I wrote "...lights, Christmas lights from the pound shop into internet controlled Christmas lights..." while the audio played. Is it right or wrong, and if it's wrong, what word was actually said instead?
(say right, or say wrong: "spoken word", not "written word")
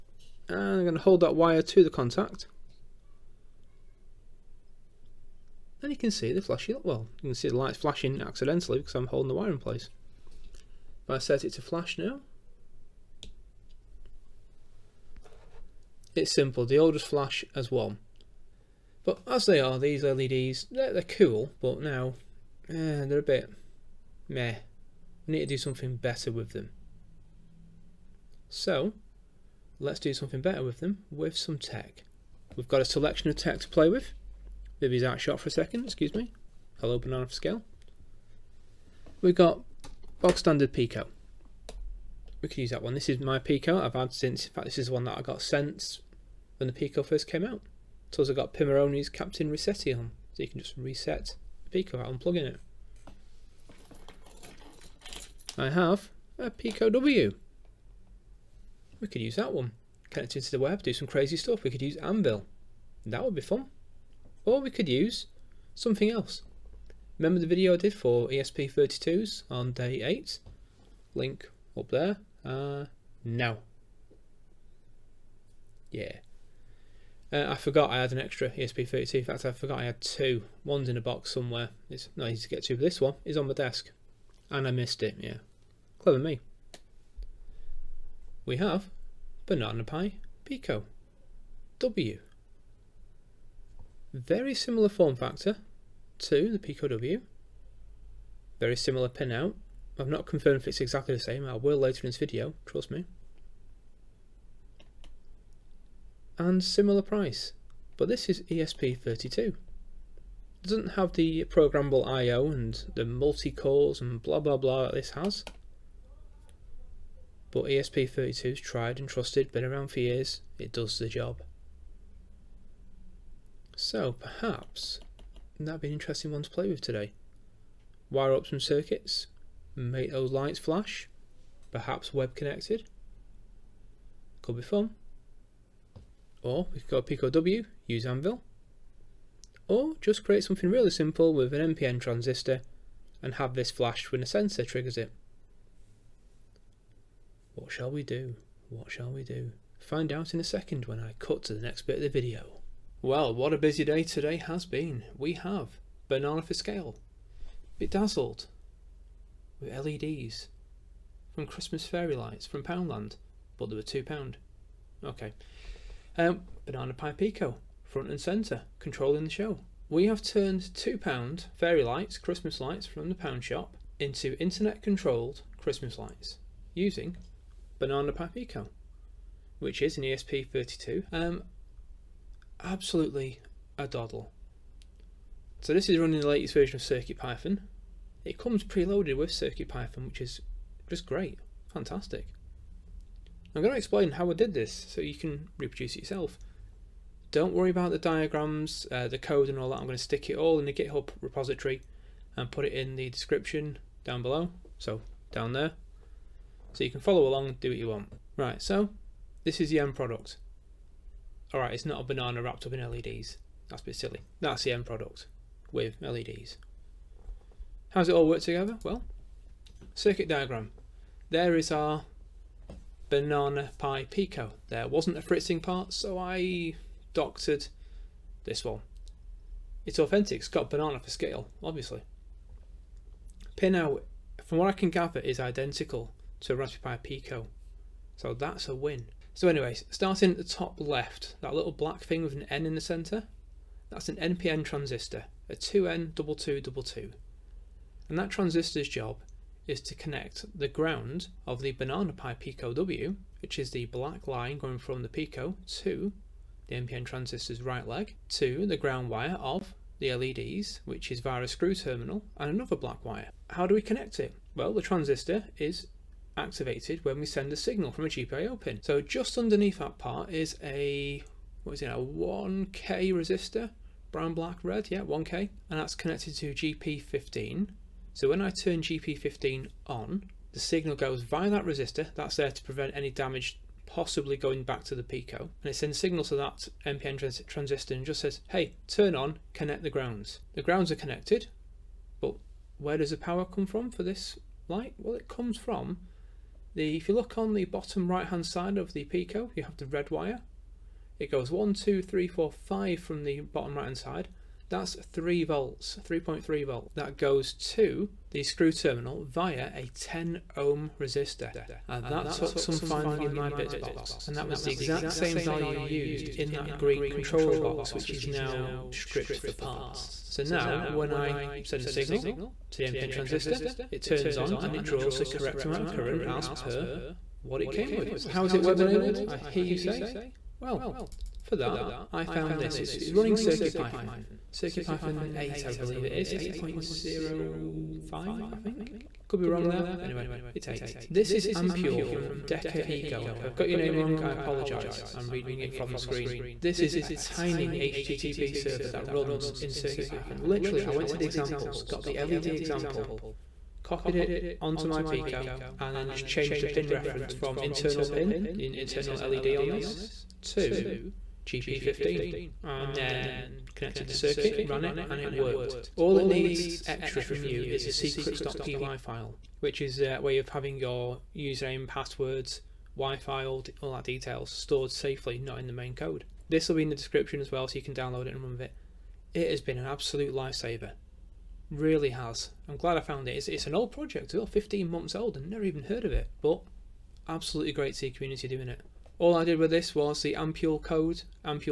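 right.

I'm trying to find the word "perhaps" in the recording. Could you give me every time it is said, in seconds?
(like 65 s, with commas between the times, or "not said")
124 s, 131 s.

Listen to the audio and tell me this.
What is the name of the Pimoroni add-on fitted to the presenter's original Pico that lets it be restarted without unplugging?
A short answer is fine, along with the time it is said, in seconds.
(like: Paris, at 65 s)
Captain Resetti, at 49 s.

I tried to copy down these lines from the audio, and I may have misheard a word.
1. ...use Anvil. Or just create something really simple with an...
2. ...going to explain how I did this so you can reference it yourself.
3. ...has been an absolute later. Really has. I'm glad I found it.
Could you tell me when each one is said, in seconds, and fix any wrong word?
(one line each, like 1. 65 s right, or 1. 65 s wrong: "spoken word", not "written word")
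1. 137 s right
2. 193 s wrong: "reproduce", not "reference"
3. 379 s wrong: "lifesaver", not "later".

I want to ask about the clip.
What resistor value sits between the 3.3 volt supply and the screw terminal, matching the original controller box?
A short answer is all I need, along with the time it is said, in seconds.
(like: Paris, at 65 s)
10 ohm, at 309 s.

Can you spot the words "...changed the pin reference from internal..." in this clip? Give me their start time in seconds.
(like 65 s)
356 s.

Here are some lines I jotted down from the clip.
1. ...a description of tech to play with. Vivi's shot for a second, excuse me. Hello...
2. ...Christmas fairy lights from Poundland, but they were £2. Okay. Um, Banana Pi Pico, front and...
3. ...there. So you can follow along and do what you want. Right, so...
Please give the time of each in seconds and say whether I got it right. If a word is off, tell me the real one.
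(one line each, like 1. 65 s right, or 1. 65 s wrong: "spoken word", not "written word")
1. 32 s wrong: "selection", not "description"
2. 161 s right
3. 205 s right.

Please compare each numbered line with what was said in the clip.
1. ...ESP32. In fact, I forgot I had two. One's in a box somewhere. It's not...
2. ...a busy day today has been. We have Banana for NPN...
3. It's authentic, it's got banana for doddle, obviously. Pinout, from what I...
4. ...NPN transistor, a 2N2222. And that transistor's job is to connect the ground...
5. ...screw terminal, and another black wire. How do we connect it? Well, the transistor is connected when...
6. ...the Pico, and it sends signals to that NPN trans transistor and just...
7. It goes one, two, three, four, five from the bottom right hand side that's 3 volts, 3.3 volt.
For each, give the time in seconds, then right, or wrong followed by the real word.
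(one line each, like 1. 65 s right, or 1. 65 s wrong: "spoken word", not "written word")
1. 78 s right
2. 153 s wrong: "Scale", not "NPN"
3. 229 s wrong: "scale", not "doddle"
4. 244 s right
5. 261 s wrong: "activated", not "connected"
6. 284 s right
7. 301 s right.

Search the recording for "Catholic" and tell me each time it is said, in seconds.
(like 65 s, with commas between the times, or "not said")
not said.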